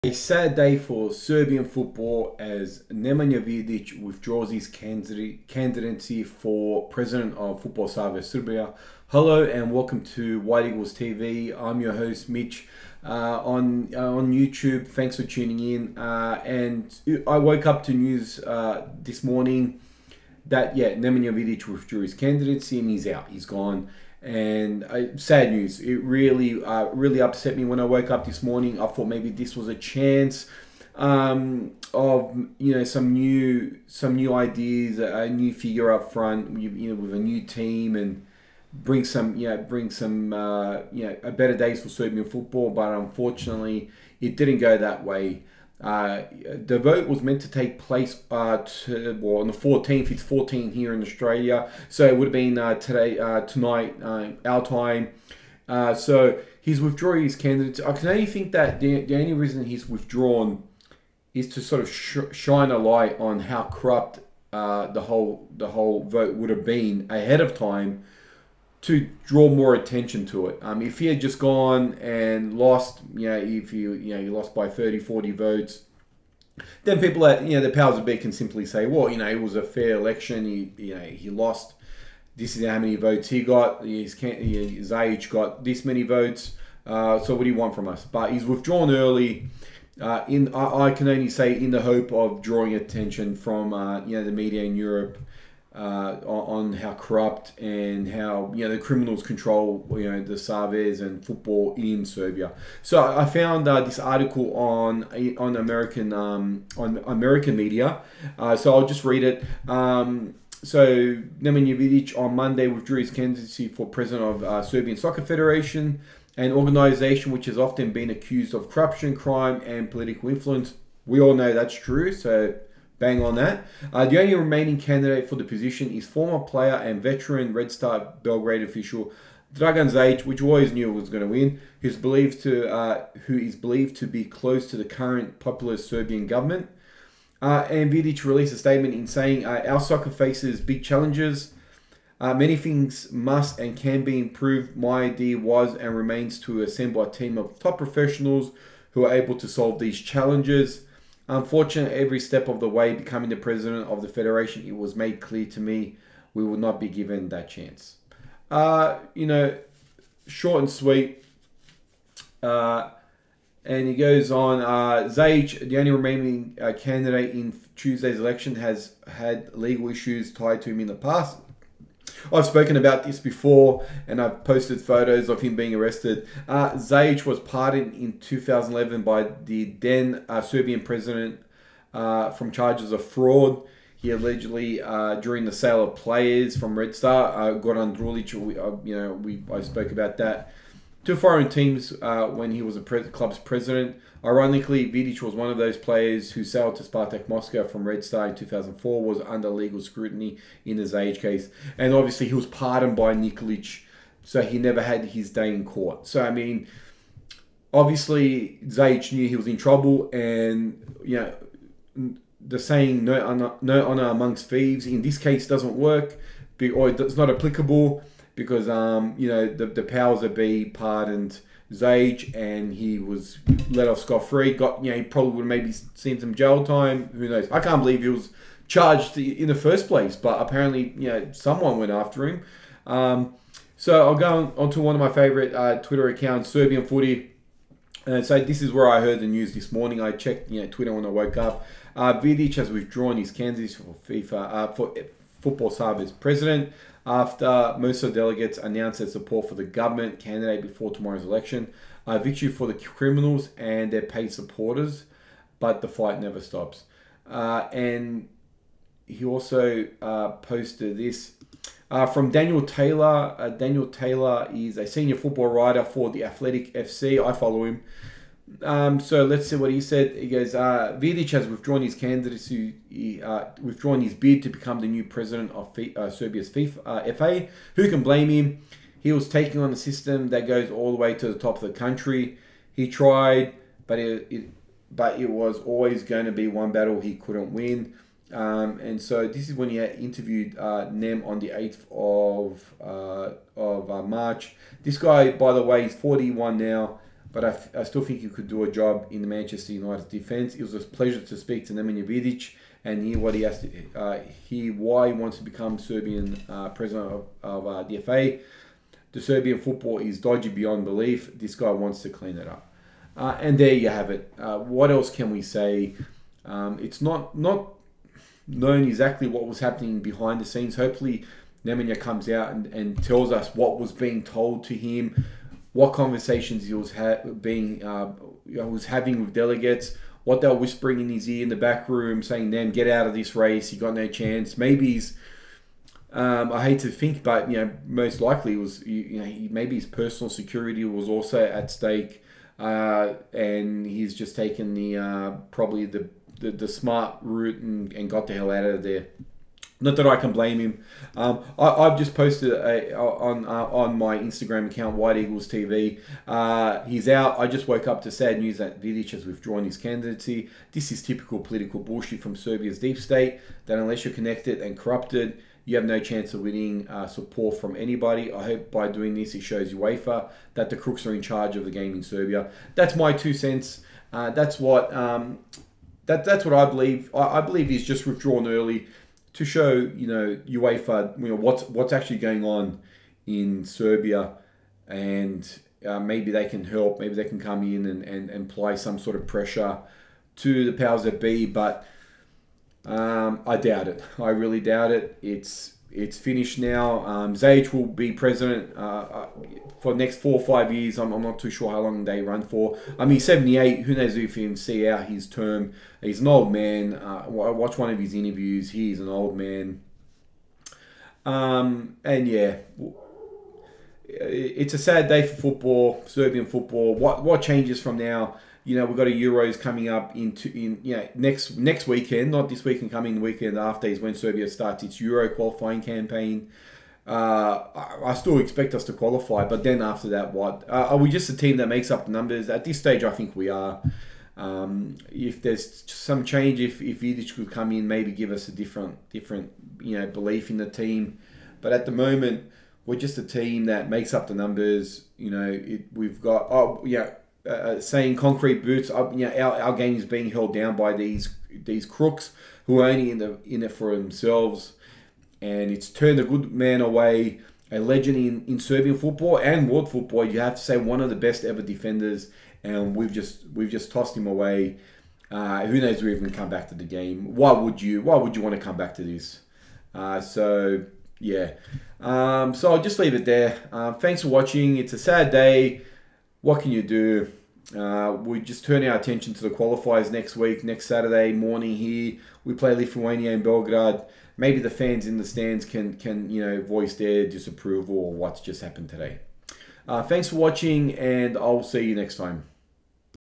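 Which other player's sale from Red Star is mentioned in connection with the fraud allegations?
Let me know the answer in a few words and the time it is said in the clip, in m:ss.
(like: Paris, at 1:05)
Goran Drulic, at 3:07.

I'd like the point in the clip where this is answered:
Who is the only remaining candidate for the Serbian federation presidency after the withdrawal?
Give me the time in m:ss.
2:09.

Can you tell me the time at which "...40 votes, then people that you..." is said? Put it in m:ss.
1:14.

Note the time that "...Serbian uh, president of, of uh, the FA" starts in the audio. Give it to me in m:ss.
5:05.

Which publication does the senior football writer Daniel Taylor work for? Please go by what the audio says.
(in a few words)
The Athletic.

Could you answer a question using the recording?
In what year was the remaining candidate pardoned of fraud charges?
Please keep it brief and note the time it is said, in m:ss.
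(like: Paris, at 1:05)
2011, at 2:58.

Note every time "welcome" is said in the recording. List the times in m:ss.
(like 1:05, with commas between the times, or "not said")
0:09.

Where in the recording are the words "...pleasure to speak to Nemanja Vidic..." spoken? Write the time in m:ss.
5:00.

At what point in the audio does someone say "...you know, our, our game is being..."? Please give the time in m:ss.
7:29.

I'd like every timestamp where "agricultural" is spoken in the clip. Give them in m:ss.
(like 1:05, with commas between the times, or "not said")
not said.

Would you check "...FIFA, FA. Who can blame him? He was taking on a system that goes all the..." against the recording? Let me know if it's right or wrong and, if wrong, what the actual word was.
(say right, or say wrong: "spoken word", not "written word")
right.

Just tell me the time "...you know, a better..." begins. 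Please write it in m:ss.
0:40.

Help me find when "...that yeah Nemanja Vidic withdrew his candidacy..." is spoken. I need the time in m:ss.
0:20.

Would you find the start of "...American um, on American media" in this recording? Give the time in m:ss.
1:45.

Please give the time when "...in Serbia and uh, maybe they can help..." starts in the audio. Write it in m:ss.
6:23.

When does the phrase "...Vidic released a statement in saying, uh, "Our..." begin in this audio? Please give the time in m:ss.
2:17.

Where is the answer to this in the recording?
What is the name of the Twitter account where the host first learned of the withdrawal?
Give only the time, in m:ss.
3:56.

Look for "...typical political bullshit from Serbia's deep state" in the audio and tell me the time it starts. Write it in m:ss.
6:01.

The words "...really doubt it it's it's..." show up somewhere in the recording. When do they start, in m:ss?
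6:34.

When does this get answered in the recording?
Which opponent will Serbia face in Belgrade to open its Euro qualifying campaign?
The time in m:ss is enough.
8:02.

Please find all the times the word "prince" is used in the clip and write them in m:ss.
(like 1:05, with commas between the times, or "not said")
not said.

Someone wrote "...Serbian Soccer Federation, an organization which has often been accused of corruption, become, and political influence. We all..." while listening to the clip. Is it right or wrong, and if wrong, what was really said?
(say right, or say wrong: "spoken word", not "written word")
wrong: "crime", not "become".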